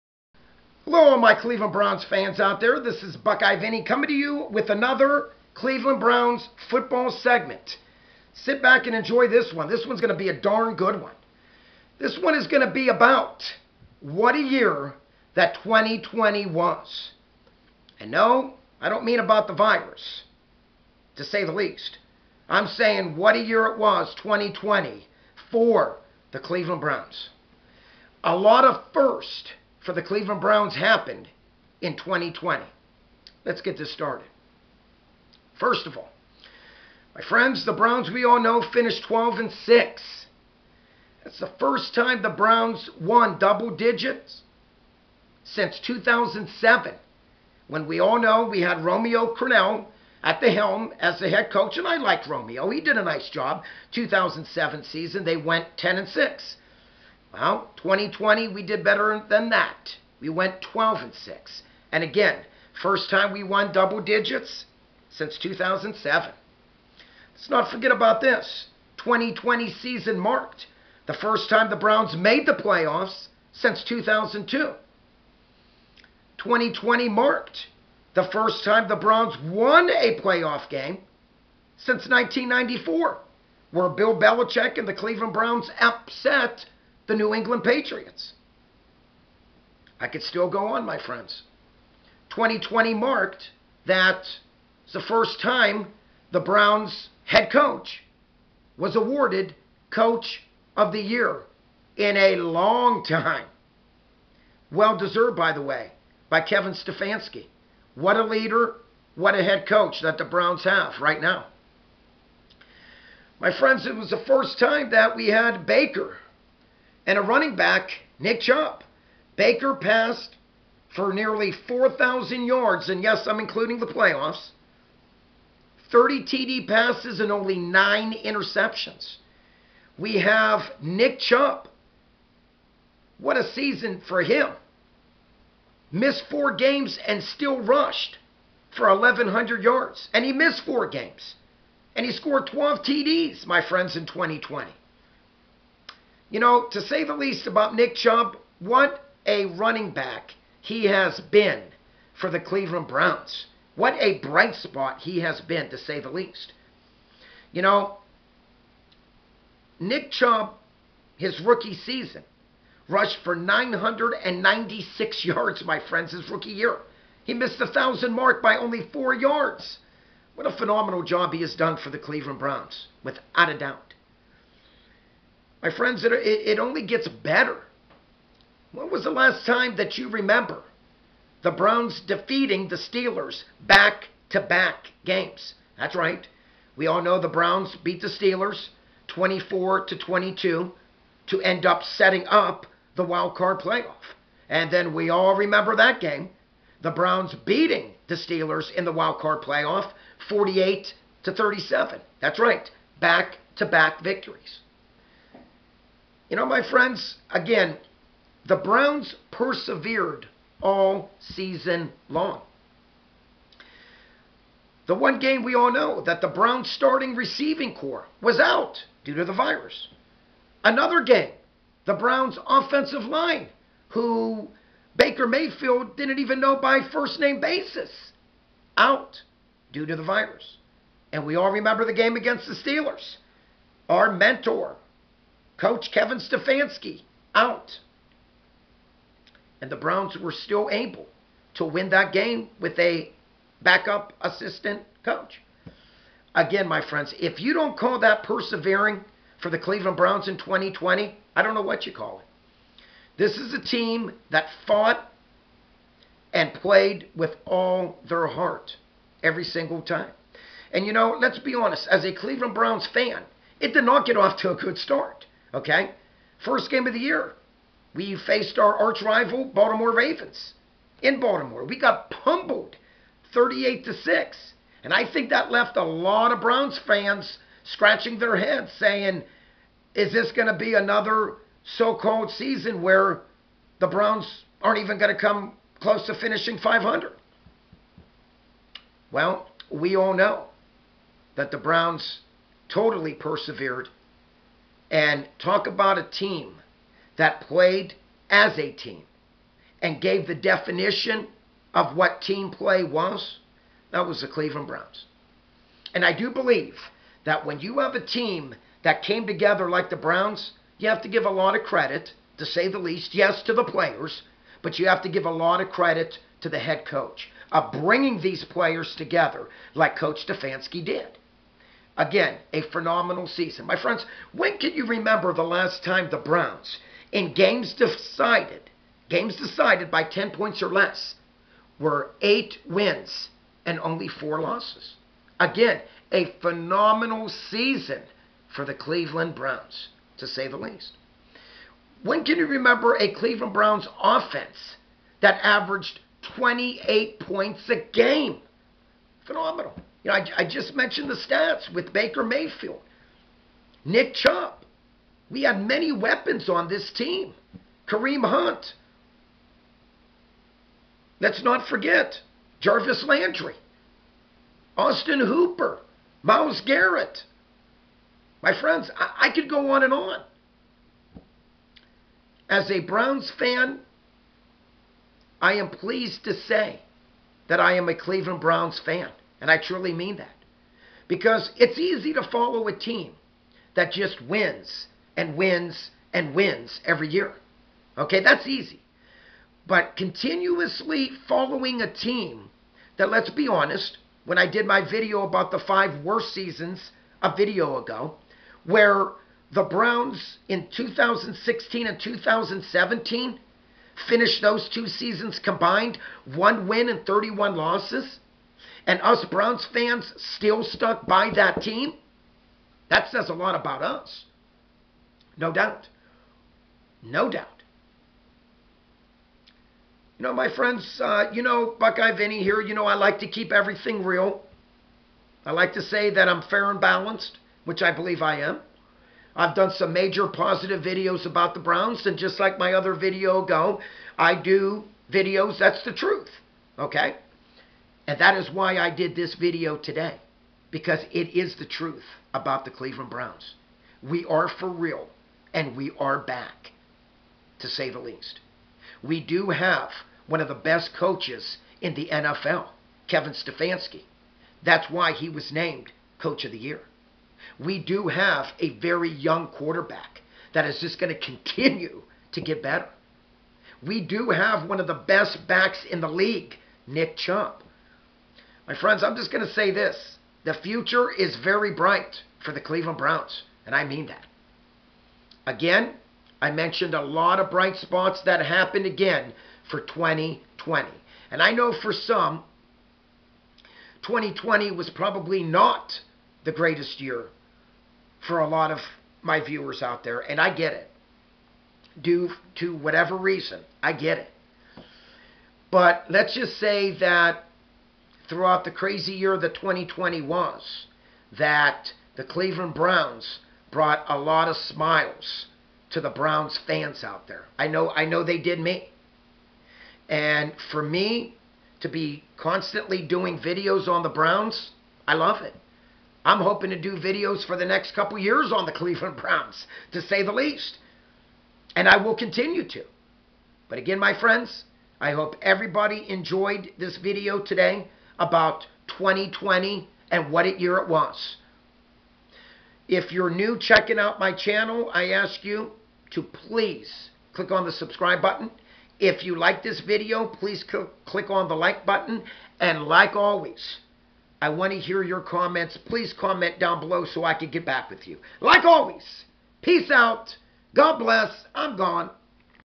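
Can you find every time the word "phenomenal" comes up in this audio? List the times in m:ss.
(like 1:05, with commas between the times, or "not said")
2:50, 5:22, 5:36, 5:49.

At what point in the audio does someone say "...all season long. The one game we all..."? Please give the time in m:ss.
3:30.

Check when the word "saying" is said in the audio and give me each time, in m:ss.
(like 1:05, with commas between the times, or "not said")
0:22, 4:38.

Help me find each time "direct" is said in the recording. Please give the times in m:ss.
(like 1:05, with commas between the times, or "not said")
not said.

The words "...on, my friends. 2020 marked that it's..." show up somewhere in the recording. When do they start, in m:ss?
1:30.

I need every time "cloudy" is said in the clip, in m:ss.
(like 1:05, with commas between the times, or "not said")
not said.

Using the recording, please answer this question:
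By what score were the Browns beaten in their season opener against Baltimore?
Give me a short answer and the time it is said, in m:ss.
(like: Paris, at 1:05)
38 to 6, at 4:33.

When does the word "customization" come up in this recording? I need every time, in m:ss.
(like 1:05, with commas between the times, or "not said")
not said.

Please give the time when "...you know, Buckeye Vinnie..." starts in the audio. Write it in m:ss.
7:01.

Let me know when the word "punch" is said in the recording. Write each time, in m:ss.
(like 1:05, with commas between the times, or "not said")
not said.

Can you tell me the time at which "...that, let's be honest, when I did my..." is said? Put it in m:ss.
6:32.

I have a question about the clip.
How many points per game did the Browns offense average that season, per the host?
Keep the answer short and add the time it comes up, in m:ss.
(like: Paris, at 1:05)
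28, at 5:46.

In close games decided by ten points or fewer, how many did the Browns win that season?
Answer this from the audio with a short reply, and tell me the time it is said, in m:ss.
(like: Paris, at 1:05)
8, at 5:32.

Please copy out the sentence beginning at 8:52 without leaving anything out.
If you're new checking out my channel, I ask you to please click on the subscribe button.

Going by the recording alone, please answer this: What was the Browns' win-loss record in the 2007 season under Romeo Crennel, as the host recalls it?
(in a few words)
10 and 6.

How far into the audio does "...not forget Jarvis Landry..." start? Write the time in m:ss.
6:01.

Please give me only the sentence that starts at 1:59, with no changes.
Baker passed for nearly 4,000 yards, and yes, I'm including the playoffs, 30 TD passes, and only nine interceptions.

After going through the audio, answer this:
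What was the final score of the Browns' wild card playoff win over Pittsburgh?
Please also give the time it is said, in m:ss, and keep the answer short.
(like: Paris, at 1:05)
48 to 37, at 3:20.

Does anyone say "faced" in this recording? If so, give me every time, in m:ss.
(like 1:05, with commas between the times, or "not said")
4:28.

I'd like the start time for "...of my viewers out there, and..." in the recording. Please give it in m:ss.
8:08.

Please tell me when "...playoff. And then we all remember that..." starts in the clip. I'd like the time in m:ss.
3:13.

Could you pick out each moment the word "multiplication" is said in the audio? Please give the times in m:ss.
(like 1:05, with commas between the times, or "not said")
not said.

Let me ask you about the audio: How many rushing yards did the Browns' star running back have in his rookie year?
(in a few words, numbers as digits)
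996.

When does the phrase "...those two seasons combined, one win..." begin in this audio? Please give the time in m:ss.
6:44.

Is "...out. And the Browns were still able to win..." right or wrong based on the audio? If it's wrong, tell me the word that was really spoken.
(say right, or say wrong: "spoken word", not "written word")
right.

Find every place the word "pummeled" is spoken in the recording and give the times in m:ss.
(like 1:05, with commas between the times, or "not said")
4:32.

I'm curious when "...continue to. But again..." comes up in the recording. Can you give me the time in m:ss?
8:42.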